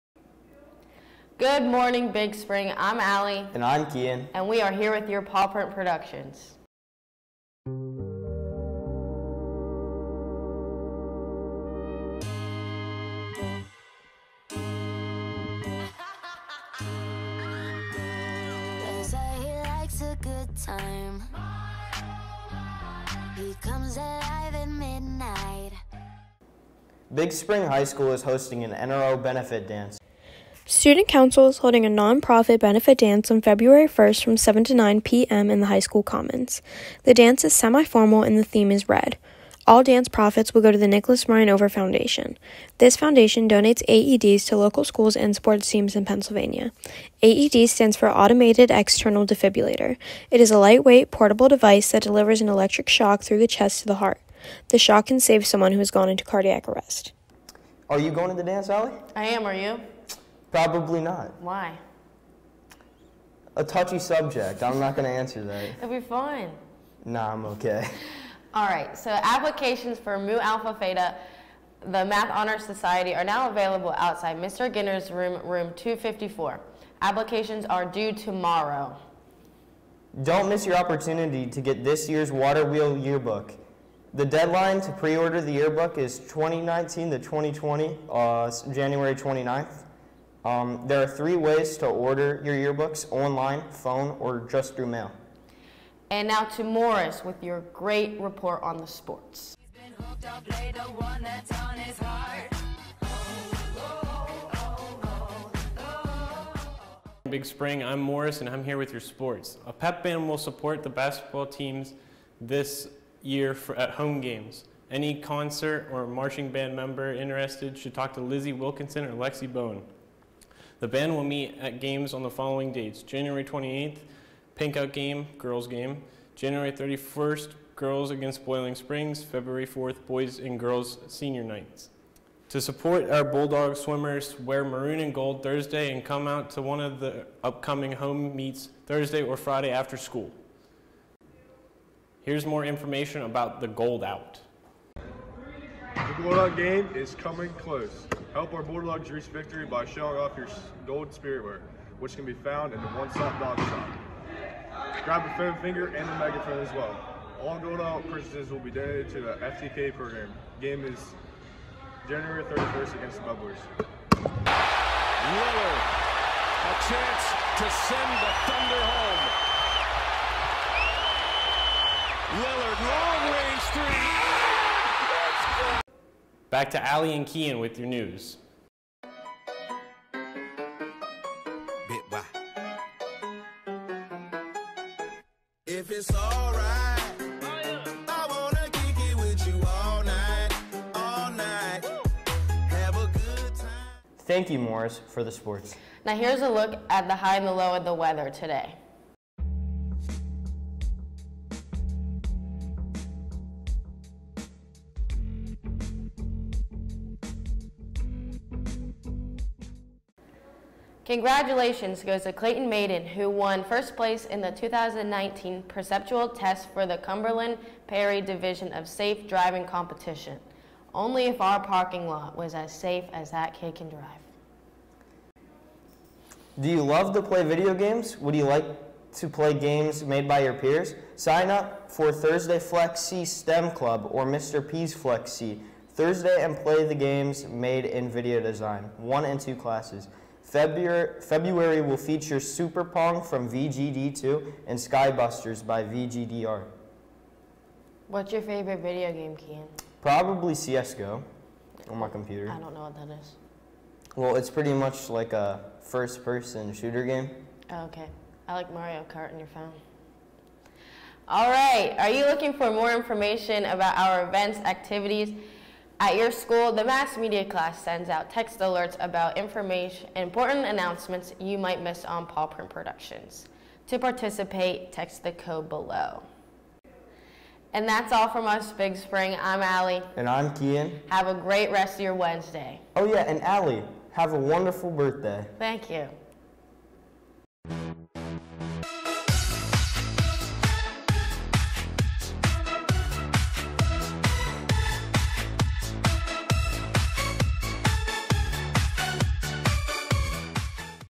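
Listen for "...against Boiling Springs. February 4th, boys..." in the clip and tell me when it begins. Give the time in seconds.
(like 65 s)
128 s.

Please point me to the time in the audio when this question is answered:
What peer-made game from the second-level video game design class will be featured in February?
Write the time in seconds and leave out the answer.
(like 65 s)
242 s.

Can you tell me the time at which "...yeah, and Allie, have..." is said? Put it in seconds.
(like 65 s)
283 s.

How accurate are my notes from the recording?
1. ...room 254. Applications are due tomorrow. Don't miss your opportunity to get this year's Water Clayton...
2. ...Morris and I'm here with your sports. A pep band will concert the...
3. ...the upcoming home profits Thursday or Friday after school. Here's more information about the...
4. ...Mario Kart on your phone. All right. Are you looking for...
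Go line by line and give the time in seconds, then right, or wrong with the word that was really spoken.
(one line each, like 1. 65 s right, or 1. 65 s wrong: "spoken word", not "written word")
1. 75 s wrong: "Wheel", not "Clayton"
2. 107 s wrong: "support", not "concert"
3. 136 s wrong: "meets", not "profits"
4. 258 s right.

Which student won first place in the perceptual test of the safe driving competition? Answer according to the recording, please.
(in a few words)
Clayton Maiden.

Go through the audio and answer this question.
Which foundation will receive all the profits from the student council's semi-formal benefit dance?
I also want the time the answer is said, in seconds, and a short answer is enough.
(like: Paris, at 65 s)
Nicholas Ryan Over Foundation, at 40 s.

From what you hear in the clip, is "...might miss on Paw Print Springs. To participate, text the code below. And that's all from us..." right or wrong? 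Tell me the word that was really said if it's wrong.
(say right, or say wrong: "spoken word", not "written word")
wrong: "Productions", not "Springs".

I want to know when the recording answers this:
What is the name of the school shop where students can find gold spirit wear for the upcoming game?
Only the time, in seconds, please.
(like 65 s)
152 s.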